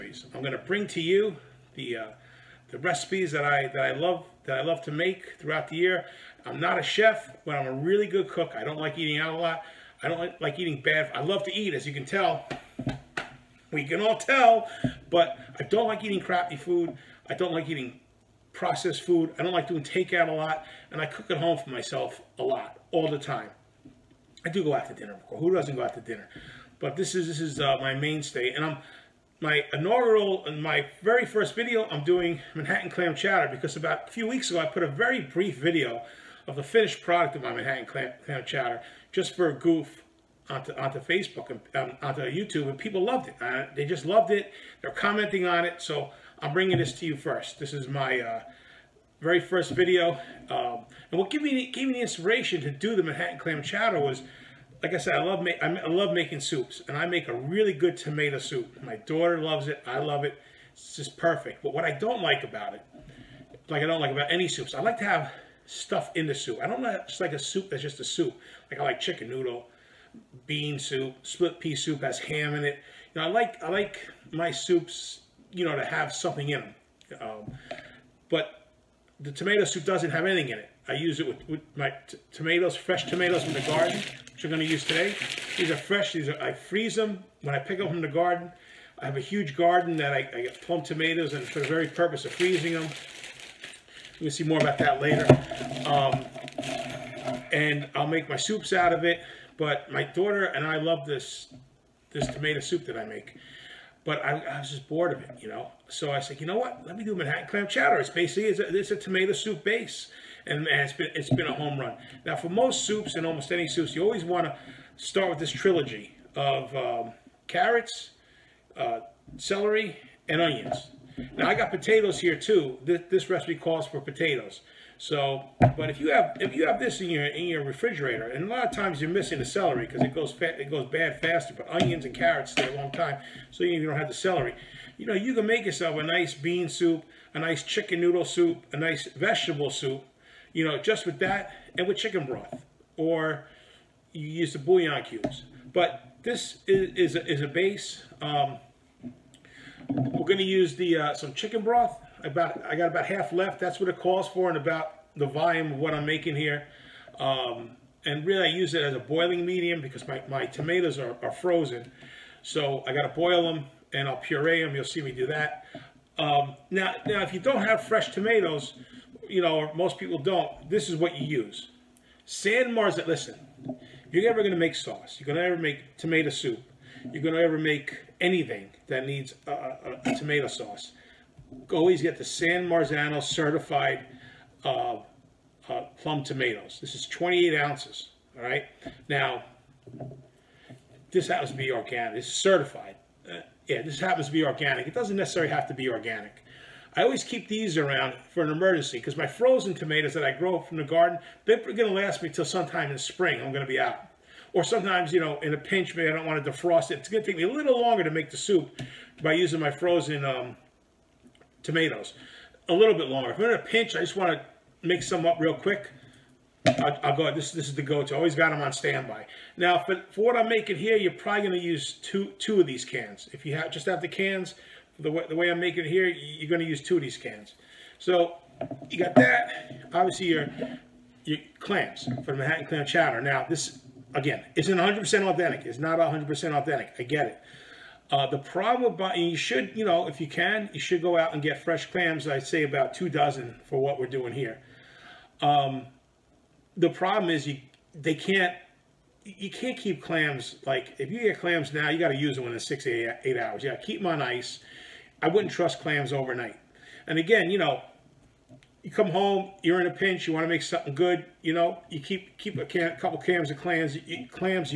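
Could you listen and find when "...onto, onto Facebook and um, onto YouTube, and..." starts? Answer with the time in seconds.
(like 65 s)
40 s.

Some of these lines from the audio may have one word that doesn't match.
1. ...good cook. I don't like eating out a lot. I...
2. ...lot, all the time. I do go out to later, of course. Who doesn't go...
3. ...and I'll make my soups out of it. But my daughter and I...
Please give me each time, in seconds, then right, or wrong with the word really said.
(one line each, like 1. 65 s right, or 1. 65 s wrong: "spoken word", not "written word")
1. 8 s right
2. 22 s wrong: "dinner", not "later"
3. 97 s right.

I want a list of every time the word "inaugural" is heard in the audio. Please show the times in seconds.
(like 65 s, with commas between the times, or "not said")
29 s.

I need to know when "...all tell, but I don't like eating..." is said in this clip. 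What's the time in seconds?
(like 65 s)
14 s.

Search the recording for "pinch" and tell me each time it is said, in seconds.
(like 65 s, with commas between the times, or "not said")
205 s, 213 s, 259 s.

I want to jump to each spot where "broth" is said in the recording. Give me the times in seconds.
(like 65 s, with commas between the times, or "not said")
142 s, 151 s.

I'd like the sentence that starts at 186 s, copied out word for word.
This is 28 ounces, all right?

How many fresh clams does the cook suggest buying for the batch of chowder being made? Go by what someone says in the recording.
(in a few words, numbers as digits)
two dozen.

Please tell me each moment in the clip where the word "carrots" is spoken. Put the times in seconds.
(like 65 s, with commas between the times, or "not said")
117 s, 132 s.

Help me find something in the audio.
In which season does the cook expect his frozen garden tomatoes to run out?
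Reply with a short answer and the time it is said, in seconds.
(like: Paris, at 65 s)
spring, at 202 s.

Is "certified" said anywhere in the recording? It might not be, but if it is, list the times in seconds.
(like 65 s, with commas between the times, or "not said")
183 s, 192 s.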